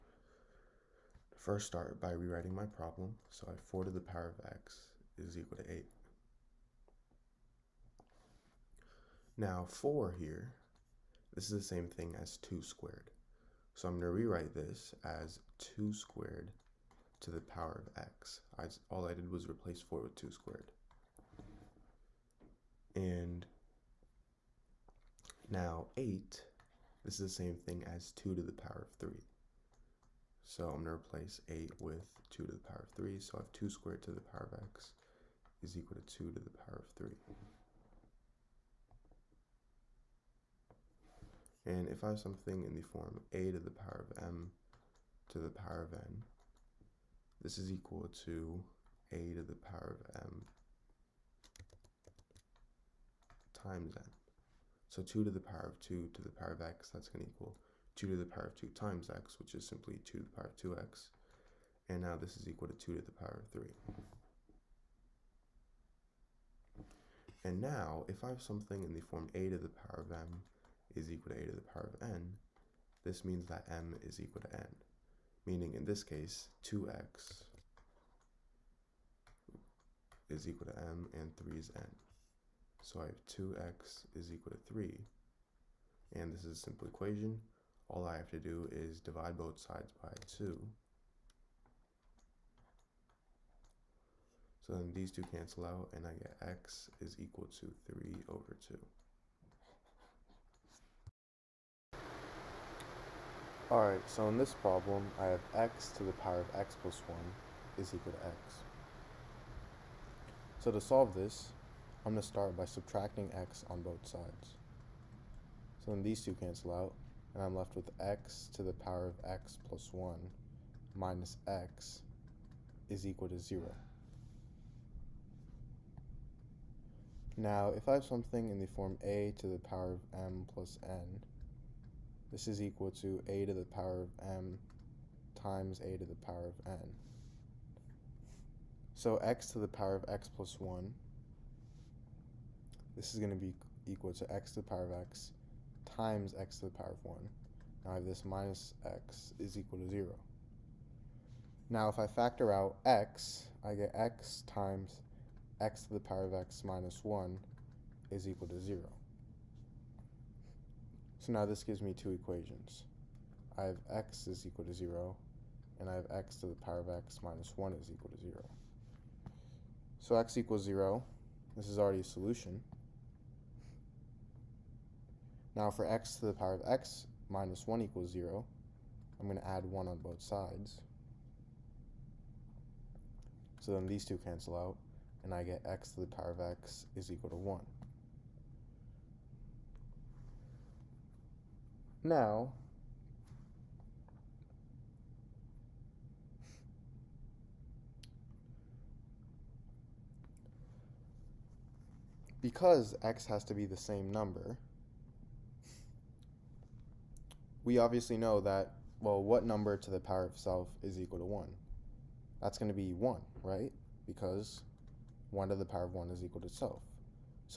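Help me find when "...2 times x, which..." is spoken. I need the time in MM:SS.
00:58.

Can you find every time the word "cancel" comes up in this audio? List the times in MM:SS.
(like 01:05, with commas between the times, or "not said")
01:35, 01:56, 03:04.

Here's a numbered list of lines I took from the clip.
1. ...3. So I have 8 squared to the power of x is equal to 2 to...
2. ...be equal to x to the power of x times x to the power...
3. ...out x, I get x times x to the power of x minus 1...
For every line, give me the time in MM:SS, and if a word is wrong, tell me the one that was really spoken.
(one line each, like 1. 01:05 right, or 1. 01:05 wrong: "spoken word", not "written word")
1. 00:32 wrong: "2", not "8"
2. 02:23 right
3. 02:32 right.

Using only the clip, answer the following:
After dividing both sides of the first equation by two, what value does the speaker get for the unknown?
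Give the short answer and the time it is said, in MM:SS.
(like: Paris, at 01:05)
3/2, at 01:37.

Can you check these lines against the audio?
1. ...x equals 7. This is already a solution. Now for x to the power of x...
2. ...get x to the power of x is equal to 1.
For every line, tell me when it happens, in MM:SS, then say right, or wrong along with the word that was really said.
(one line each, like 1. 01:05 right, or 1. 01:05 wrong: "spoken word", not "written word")
1. 02:50 wrong: "0", not "7"
2. 03:05 right.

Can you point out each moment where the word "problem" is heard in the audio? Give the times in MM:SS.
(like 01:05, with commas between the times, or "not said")
00:02, 01:44.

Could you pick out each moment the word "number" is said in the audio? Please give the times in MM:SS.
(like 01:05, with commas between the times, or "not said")
03:24, 03:29.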